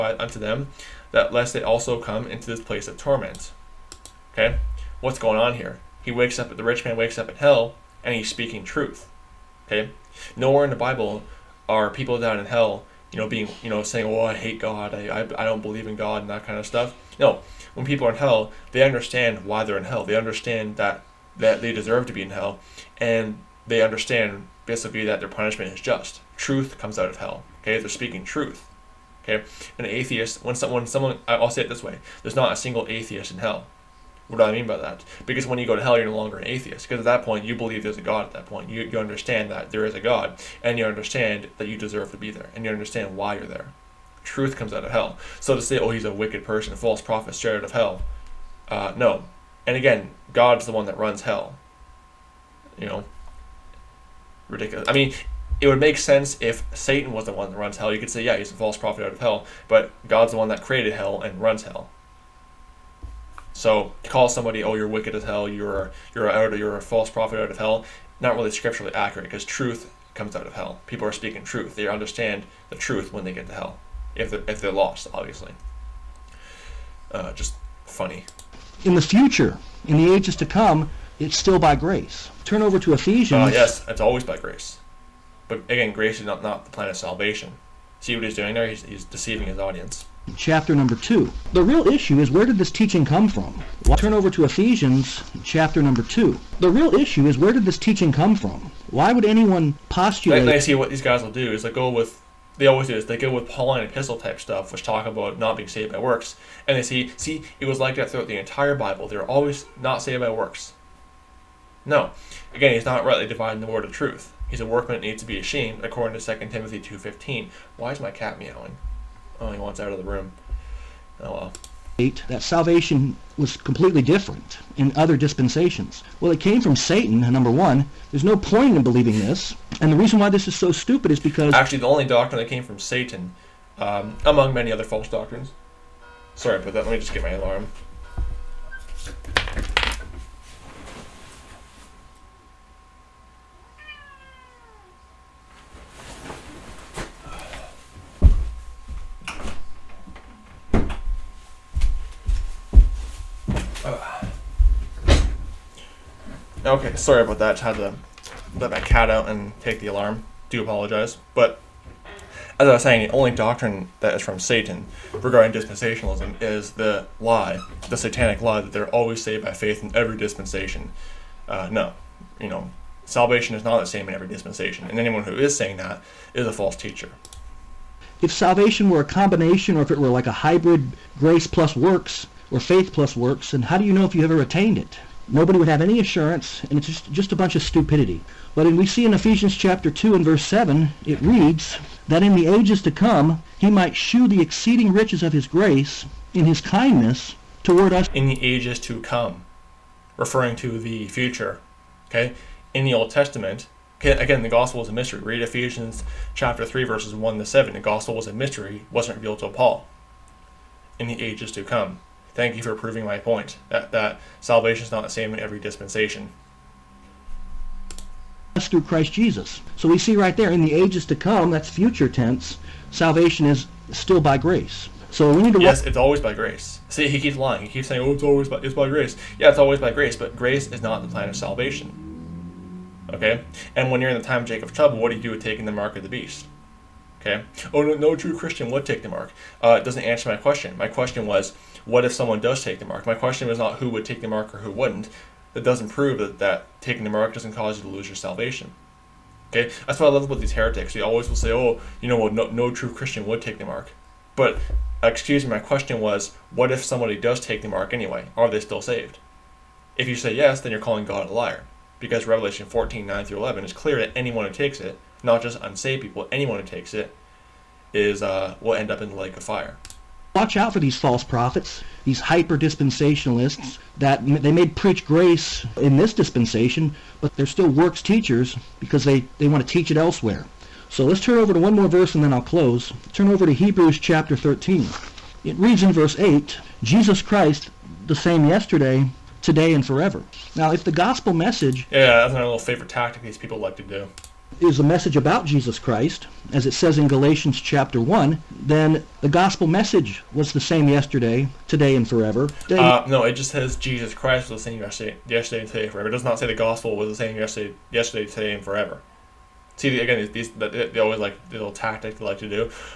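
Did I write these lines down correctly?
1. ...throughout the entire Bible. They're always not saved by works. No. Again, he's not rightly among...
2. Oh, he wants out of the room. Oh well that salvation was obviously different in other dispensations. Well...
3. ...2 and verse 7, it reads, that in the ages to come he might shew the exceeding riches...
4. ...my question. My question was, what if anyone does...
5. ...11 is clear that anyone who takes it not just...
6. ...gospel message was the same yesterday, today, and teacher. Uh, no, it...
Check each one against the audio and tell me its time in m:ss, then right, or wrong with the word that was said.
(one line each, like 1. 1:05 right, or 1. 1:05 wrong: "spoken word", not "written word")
1. 1:48 wrong: "dividing", not "among"
2. 1:59 wrong: "completely", not "obviously"
3. 3:09 right
4. 4:00 wrong: "someone", not "anyone"
5. 4:23 right
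6. 4:59 wrong: "forever", not "teacher".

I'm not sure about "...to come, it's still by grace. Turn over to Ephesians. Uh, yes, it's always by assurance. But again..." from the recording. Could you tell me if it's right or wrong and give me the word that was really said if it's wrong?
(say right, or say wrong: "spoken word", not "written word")
wrong: "grace", not "assurance".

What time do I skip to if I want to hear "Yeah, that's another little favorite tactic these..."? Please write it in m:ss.
4:51.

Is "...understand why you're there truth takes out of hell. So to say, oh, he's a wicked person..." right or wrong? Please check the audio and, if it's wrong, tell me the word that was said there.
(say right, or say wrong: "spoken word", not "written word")
wrong: "comes", not "takes".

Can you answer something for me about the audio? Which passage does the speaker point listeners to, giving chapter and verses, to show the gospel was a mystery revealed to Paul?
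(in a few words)
Ephesians 3:1-7.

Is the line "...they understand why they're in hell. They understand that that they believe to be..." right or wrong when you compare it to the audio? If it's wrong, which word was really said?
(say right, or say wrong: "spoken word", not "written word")
wrong: "deserve", not "believe".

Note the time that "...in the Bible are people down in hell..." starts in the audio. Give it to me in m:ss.
0:10.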